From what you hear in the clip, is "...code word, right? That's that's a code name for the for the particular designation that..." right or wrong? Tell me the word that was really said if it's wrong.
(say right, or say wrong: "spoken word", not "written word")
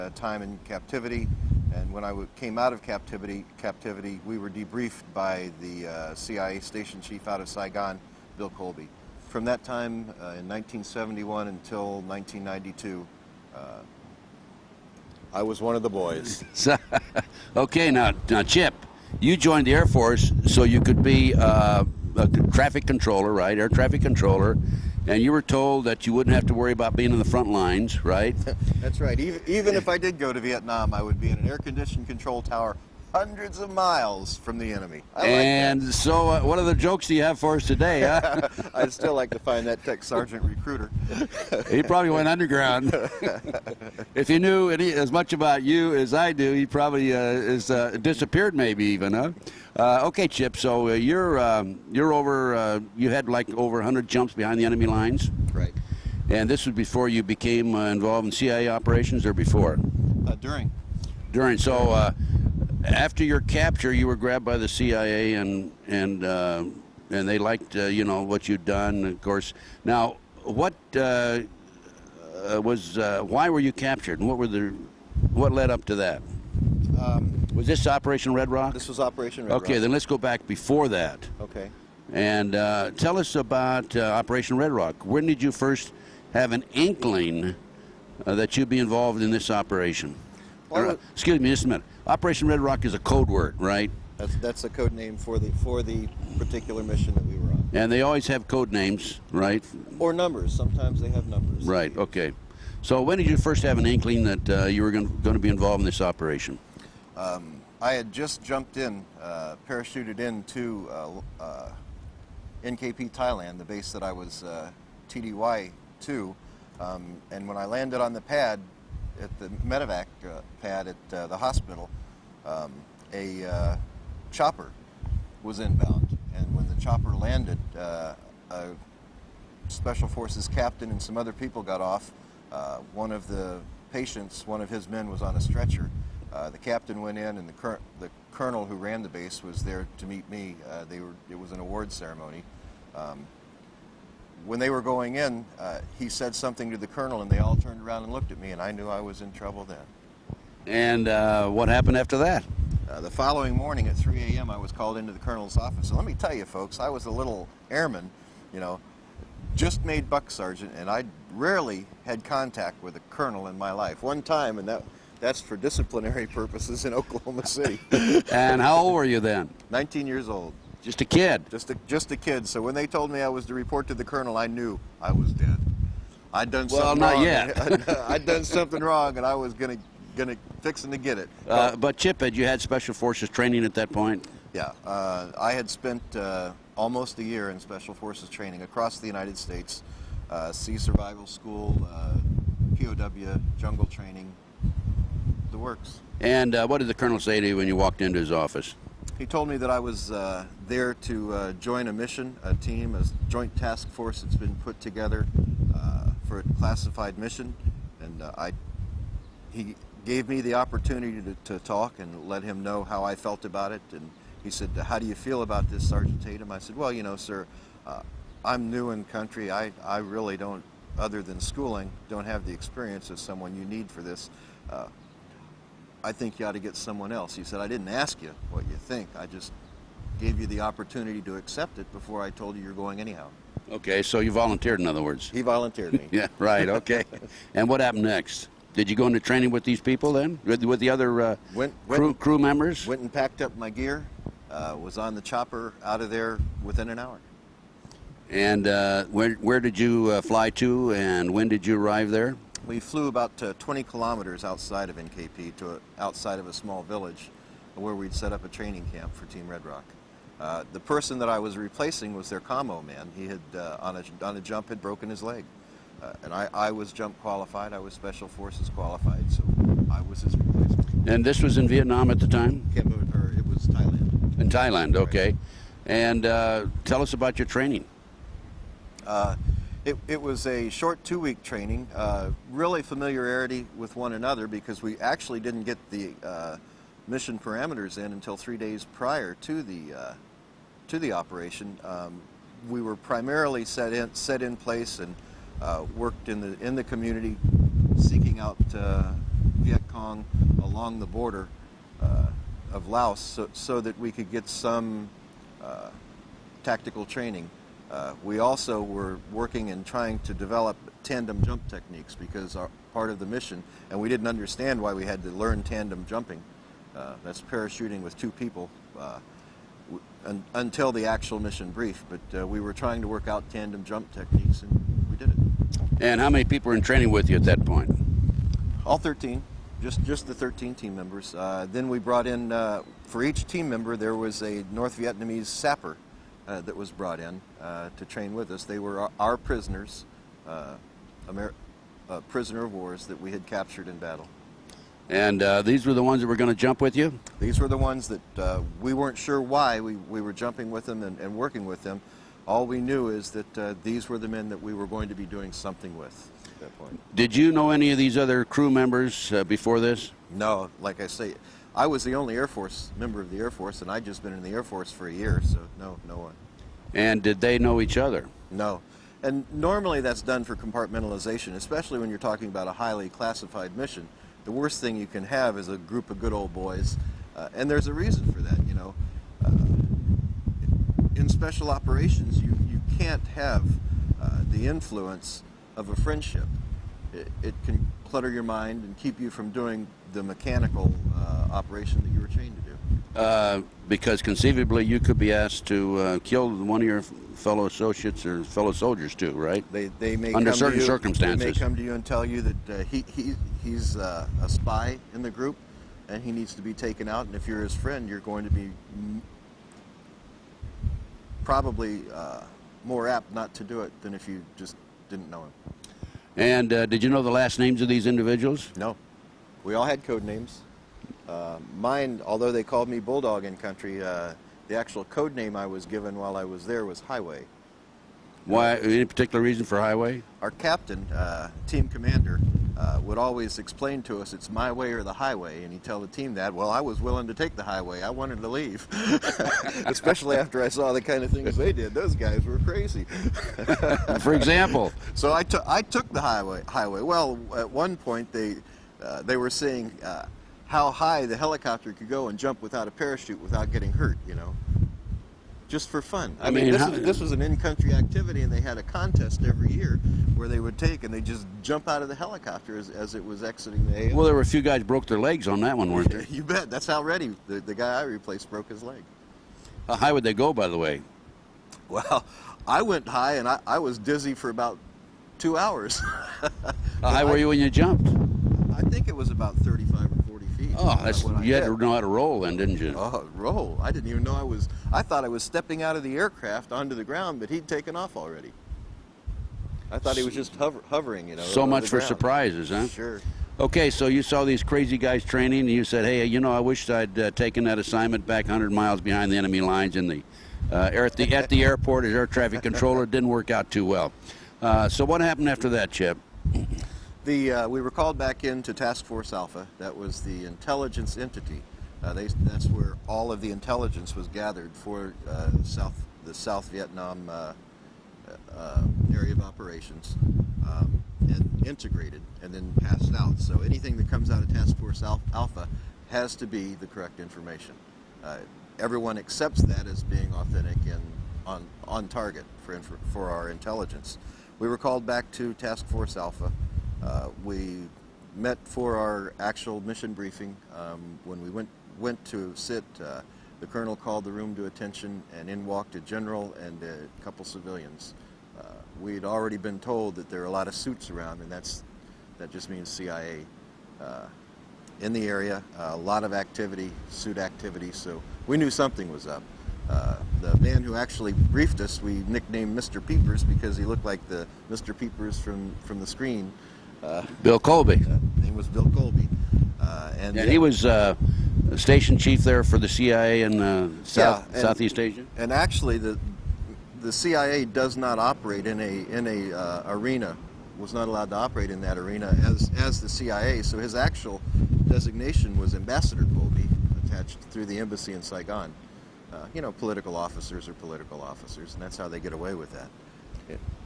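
wrong: "mission", not "designation".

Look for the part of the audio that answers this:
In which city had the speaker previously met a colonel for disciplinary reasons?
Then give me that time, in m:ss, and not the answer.
2:46.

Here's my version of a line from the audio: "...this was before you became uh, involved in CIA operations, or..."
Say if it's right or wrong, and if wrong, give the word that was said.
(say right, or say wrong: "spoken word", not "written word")
right.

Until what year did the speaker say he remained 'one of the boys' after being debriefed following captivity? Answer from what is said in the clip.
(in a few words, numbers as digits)
1992.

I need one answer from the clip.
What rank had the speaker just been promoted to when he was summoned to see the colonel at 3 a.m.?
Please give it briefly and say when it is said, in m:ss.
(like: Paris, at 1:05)
buck sergeant, at 2:40.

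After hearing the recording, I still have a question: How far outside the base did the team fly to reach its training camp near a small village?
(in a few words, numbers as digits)
20 kilometers.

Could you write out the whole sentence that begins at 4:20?
Uh, the person that I was replacing was their commo man.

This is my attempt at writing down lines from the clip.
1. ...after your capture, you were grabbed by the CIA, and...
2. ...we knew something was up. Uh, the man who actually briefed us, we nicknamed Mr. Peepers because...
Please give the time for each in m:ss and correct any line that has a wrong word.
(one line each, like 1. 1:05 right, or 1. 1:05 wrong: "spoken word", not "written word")
1. 1:02 right
2. 9:18 right.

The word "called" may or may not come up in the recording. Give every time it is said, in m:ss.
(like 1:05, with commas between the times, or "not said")
2:34, 7:02, 8:27, 8:54, 9:03.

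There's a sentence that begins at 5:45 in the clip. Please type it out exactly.
And uh, these were the ones that were going to jump with you?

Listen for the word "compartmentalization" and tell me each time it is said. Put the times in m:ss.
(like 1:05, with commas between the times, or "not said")
6:10.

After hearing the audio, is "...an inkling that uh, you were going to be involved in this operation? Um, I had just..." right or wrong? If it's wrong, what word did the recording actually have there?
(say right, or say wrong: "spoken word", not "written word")
right.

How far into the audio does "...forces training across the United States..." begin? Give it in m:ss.
3:07.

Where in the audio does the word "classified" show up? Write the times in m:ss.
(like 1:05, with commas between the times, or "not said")
3:26, 6:13.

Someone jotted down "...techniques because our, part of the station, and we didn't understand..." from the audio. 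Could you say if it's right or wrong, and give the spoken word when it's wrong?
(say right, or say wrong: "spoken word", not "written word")
wrong: "mission", not "station".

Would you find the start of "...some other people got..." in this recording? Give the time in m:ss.
2:11.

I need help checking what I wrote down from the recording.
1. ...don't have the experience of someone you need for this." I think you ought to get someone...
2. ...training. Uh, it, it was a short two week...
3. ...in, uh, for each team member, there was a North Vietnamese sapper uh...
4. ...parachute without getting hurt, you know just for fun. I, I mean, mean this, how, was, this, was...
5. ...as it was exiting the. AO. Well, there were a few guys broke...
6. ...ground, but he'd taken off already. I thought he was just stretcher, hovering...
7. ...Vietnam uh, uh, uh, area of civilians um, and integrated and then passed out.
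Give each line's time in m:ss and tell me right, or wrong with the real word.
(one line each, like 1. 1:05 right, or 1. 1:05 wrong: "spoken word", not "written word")
1. 3:42 right
2. 4:37 right
3. 5:32 right
4. 7:32 right
5. 7:42 right
6. 8:07 wrong: "hover", not "stretcher"
7. 8:36 wrong: "operations", not "civilians".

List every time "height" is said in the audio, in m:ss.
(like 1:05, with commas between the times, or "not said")
not said.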